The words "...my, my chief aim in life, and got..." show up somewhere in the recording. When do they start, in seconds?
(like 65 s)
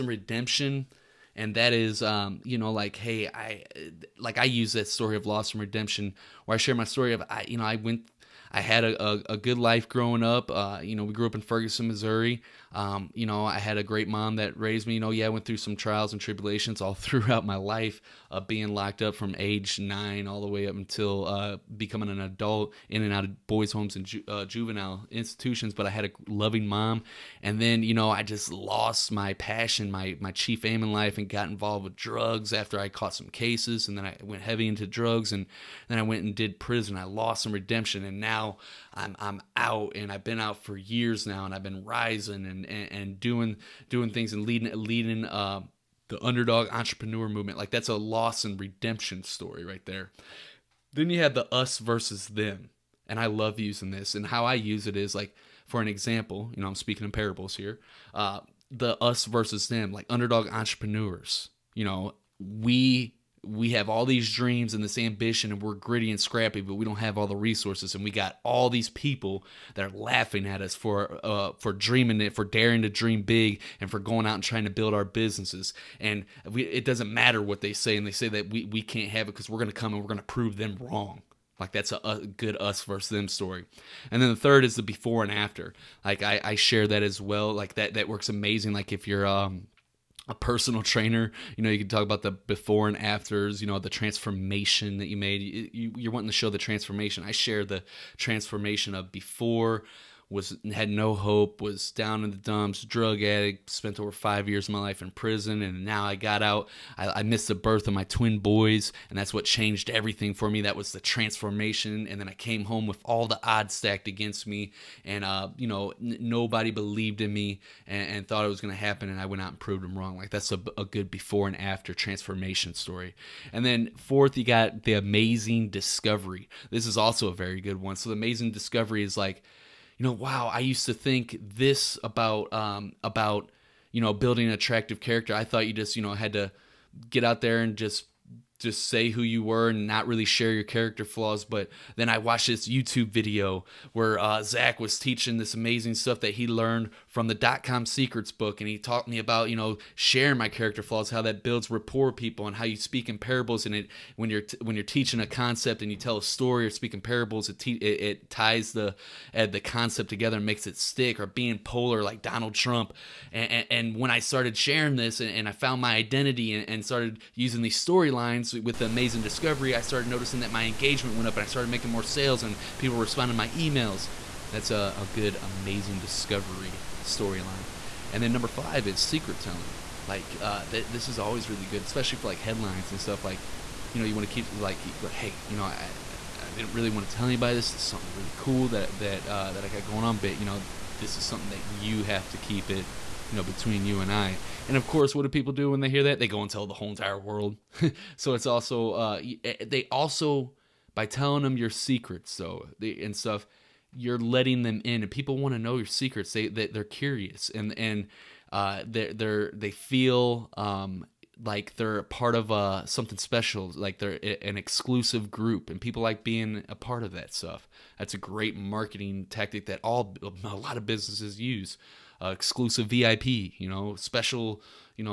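29 s.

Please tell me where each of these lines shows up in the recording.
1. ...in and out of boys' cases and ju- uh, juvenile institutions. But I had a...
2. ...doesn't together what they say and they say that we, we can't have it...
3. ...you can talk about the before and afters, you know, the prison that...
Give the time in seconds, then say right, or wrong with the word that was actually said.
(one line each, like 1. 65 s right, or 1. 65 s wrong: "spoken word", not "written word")
1. 22 s wrong: "homes", not "cases"
2. 76 s wrong: "matter", not "together"
3. 91 s wrong: "transformation", not "prison".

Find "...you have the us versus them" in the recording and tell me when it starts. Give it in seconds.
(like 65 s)
51 s.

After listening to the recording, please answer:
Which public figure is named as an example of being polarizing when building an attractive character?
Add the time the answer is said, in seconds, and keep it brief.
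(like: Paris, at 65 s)
Donald Trump, at 162 s.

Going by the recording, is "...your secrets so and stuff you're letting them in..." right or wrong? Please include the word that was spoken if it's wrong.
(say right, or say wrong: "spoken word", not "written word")
right.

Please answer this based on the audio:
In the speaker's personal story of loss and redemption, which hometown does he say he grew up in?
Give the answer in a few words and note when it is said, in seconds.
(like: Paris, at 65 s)
Ferguson, Missouri, at 11 s.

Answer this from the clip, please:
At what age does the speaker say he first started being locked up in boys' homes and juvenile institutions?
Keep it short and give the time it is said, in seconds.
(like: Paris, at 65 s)
9, at 19 s.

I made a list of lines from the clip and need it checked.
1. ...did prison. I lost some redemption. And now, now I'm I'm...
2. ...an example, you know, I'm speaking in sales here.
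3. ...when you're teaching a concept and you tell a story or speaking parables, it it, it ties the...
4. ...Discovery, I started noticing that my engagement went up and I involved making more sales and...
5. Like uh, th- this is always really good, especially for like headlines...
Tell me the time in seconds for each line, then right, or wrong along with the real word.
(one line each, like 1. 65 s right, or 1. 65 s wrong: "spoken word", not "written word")
1. 36 s right
2. 55 s wrong: "parables", not "sales"
3. 154 s right
4. 169 s wrong: "started", not "involved"
5. 180 s right.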